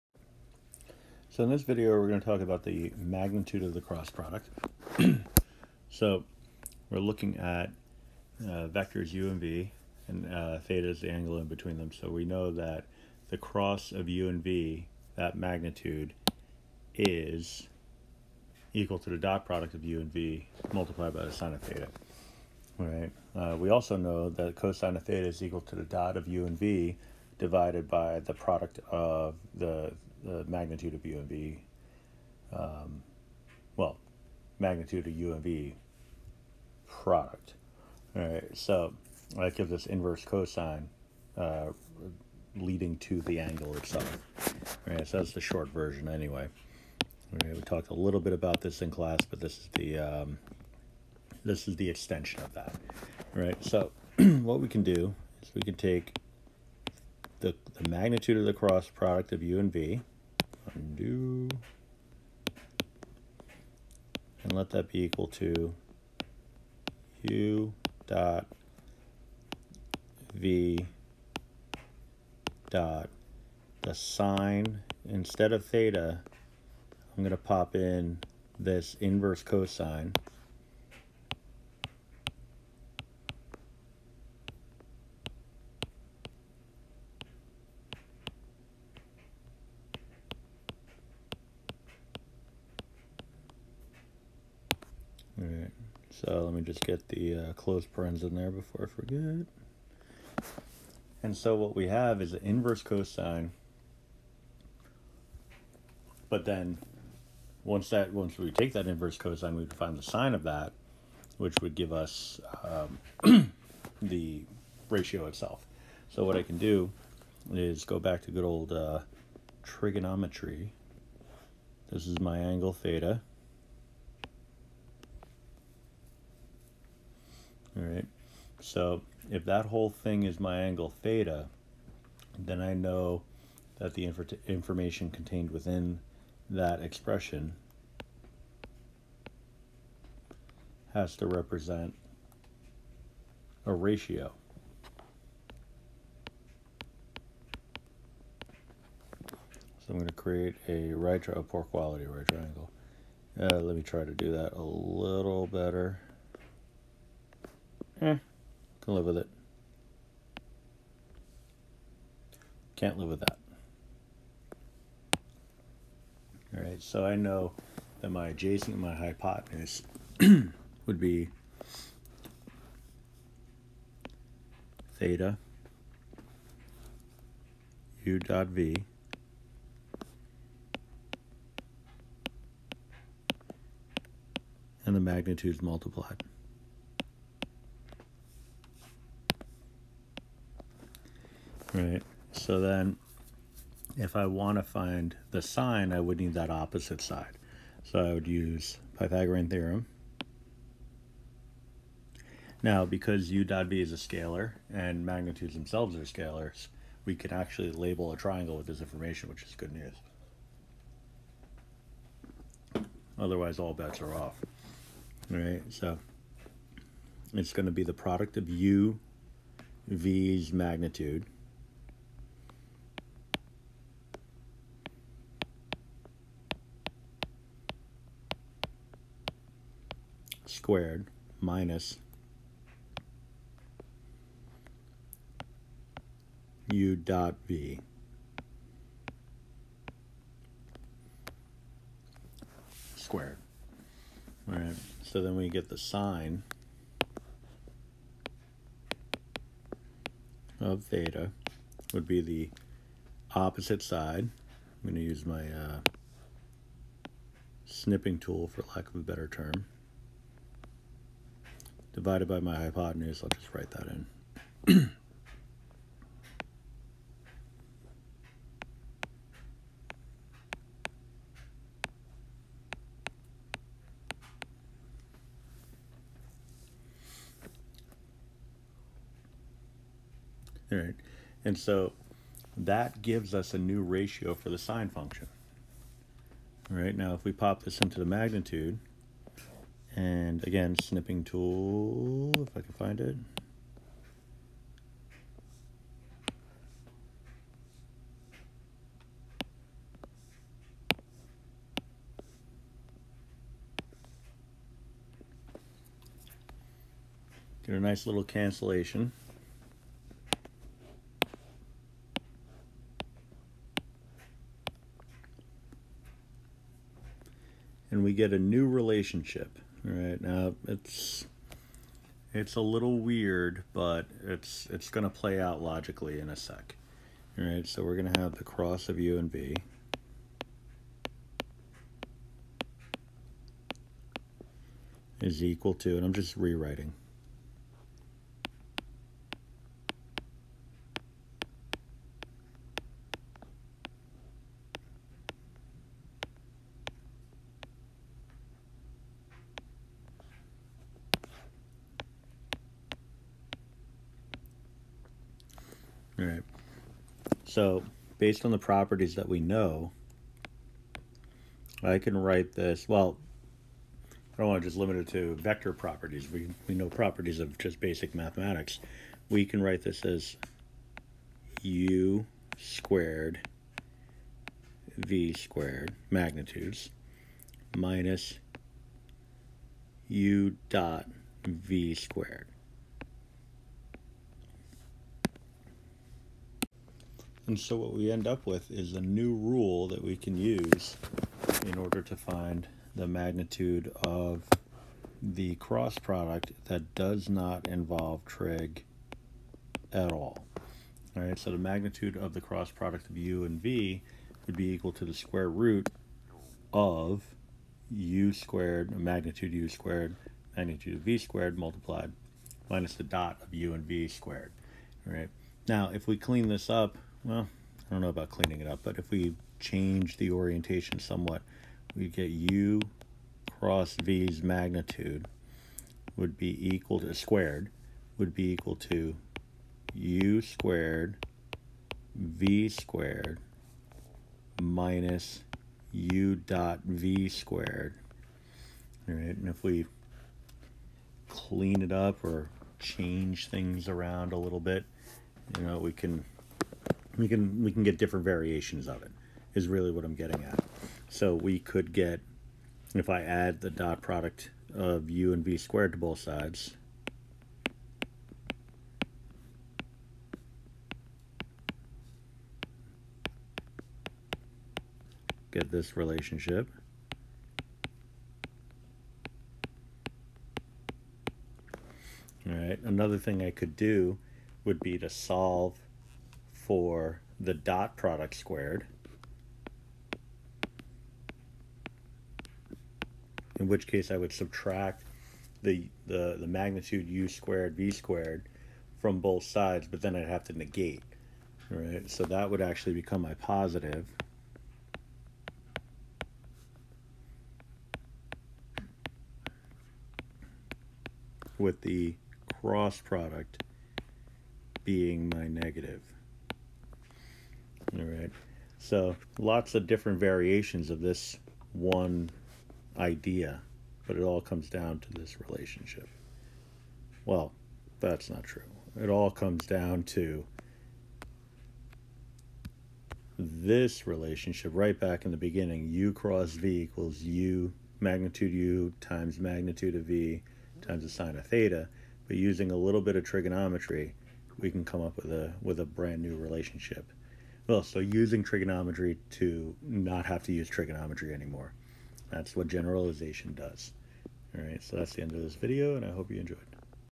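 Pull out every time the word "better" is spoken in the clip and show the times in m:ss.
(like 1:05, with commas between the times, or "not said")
2:35, 4:18.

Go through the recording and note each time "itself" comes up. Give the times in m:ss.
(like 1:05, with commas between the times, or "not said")
0:43, 1:55.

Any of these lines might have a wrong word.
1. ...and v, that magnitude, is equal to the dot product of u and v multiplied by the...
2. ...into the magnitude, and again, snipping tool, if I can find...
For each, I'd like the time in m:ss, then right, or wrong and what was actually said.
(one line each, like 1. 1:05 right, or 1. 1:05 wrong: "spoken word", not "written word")
1. 0:14 right
2. 4:47 right.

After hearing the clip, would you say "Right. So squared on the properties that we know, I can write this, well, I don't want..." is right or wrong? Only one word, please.
wrong.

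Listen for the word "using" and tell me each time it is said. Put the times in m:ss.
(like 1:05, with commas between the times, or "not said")
8:52, 8:57.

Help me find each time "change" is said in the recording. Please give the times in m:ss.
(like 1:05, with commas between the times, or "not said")
6:59, 7:22.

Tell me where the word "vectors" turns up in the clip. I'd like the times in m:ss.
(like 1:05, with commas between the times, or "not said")
0:08, 6:05.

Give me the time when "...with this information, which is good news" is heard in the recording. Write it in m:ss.
3:28.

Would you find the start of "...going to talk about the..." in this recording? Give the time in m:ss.
0:02.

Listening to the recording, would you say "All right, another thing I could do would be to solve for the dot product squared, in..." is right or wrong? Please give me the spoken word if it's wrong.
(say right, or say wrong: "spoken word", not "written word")
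right.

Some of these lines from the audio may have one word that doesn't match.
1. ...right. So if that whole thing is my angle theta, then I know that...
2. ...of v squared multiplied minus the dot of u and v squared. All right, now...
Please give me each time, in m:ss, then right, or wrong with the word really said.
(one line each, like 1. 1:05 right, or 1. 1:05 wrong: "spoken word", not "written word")
1. 2:07 right
2. 6:50 right.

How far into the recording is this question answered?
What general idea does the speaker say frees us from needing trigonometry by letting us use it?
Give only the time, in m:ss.
9:02.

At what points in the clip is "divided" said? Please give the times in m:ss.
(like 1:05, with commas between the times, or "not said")
0:27, 4:21.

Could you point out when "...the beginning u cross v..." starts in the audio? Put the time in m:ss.
8:45.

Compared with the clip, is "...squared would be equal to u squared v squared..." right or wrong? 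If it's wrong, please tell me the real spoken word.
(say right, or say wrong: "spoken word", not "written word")
right.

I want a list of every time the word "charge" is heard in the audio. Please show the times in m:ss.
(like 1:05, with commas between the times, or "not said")
not said.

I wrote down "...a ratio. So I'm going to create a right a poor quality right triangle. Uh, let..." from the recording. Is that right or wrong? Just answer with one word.
right.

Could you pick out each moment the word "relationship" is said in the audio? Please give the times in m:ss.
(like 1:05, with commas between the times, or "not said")
5:18, 7:45, 8:35, 8:44, 8:56.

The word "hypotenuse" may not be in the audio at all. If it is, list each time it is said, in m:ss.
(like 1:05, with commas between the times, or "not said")
2:48, 4:22.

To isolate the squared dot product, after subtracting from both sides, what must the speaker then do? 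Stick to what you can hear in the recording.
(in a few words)
negate.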